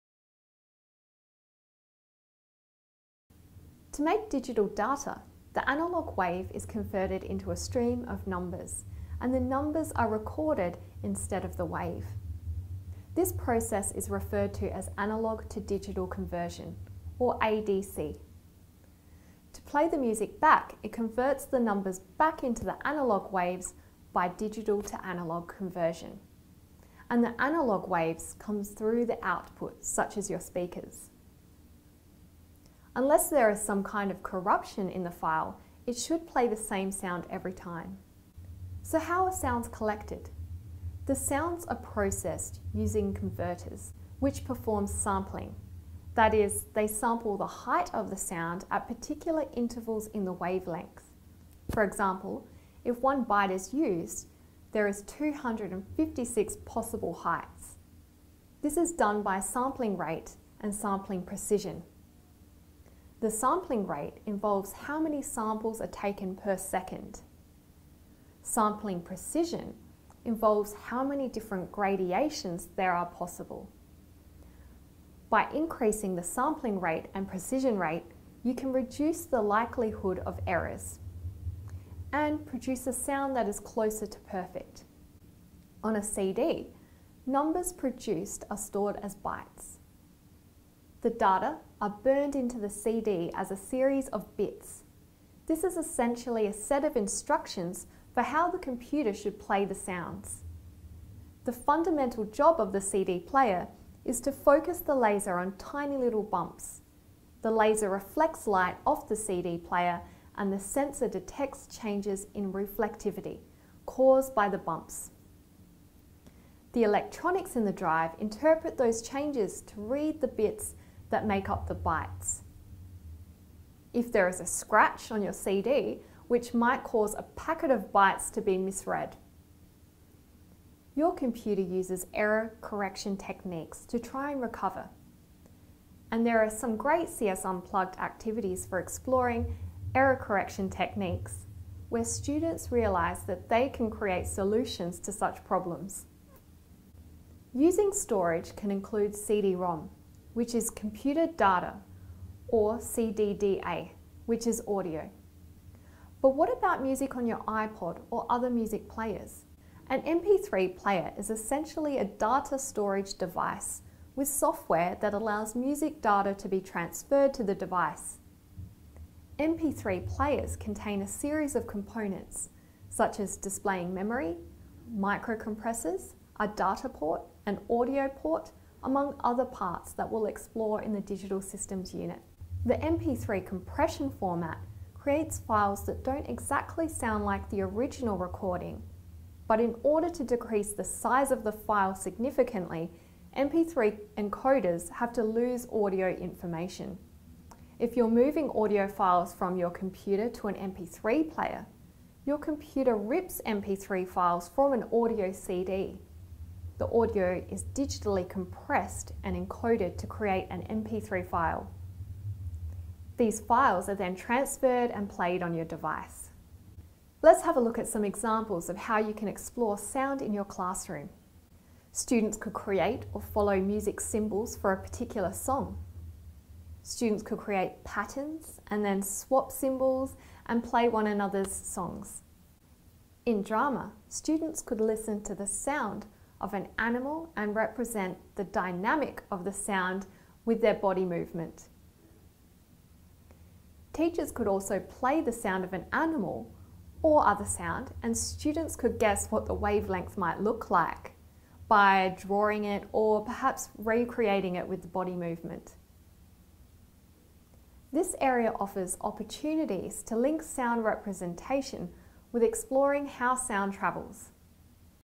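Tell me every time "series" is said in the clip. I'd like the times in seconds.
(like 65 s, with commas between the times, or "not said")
93 s, 171 s.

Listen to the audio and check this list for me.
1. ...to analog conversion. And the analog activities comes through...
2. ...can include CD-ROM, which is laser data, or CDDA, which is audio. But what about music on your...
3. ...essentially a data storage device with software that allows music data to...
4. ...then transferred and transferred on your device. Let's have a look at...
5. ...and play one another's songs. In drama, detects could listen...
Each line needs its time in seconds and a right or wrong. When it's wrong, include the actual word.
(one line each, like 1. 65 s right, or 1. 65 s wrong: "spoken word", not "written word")
1. 24 s wrong: "waves", not "activities"
2. 148 s wrong: "computer", not "laser"
3. 161 s right
4. 213 s wrong: "played", not "transferred"
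5. 230 s wrong: "students", not "detects".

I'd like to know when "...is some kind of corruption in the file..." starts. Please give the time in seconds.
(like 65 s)
33 s.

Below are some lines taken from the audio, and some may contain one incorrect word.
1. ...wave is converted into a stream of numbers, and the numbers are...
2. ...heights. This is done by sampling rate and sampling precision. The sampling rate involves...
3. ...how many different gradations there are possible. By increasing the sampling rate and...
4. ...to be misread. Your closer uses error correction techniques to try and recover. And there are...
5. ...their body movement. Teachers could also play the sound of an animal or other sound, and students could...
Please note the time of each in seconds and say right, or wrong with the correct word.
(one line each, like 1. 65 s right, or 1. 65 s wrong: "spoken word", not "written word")
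1. 6 s right
2. 57 s right
3. 70 s right
4. 128 s wrong: "computer", not "closer"
5. 240 s right.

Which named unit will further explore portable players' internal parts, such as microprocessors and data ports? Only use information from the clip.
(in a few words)
Digital Systems.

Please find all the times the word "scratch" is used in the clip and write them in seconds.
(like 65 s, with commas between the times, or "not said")
124 s.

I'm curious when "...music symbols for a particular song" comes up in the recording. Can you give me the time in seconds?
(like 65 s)
223 s.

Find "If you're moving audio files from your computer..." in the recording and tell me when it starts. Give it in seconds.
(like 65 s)
197 s.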